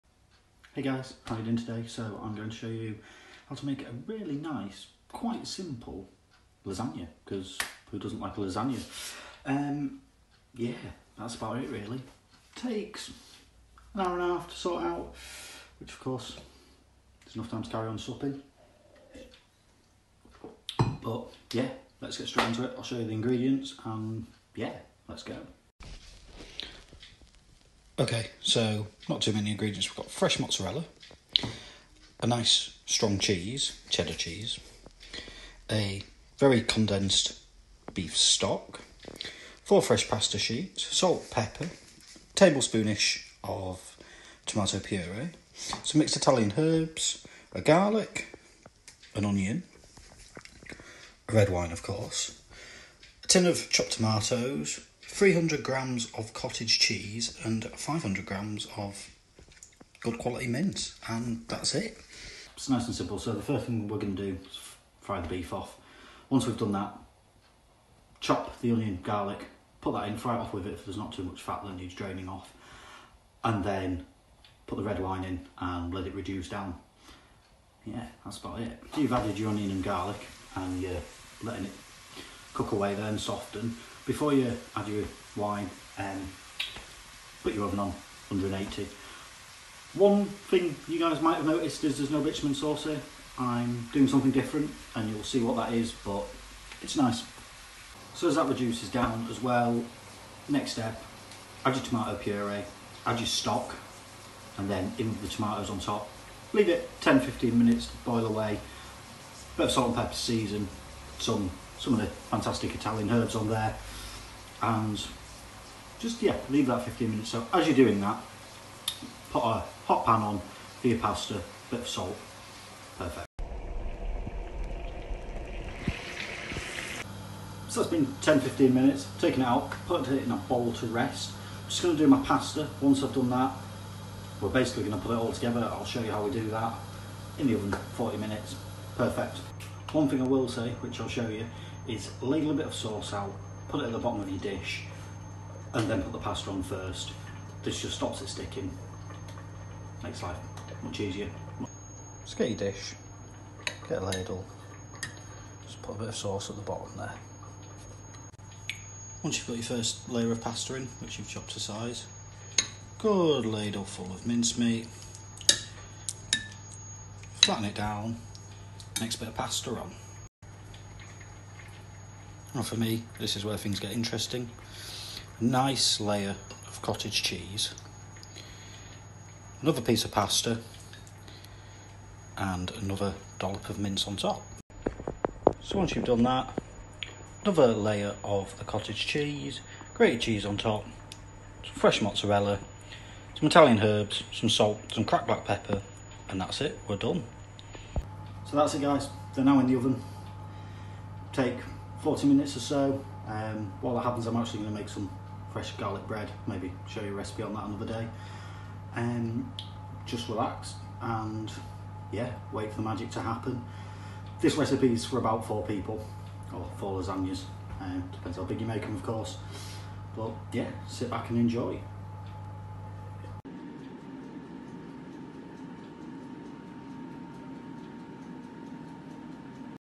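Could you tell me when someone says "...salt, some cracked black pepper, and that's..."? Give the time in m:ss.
3:14.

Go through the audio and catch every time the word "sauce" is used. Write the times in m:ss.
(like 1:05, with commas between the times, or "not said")
1:32, 2:22, 2:36.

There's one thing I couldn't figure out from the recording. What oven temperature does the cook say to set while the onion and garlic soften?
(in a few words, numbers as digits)
180.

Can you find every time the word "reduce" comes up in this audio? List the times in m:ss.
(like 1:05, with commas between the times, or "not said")
1:16, 1:38.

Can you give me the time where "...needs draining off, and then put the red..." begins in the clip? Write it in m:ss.
1:11.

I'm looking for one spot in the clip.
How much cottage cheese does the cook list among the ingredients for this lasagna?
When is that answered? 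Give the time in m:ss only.
0:55.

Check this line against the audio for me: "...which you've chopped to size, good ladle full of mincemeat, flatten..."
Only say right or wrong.
right.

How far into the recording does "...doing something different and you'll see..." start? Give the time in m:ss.
1:33.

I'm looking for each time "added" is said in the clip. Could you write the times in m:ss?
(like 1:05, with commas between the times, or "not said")
1:19.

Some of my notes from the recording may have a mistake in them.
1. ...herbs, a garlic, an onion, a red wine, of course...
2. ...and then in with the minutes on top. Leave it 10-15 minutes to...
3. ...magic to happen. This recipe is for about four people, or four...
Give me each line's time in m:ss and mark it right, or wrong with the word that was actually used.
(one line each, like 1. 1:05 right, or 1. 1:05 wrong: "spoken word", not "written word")
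1. 0:46 right
2. 1:44 wrong: "tomatoes", not "minutes"
3. 3:32 right.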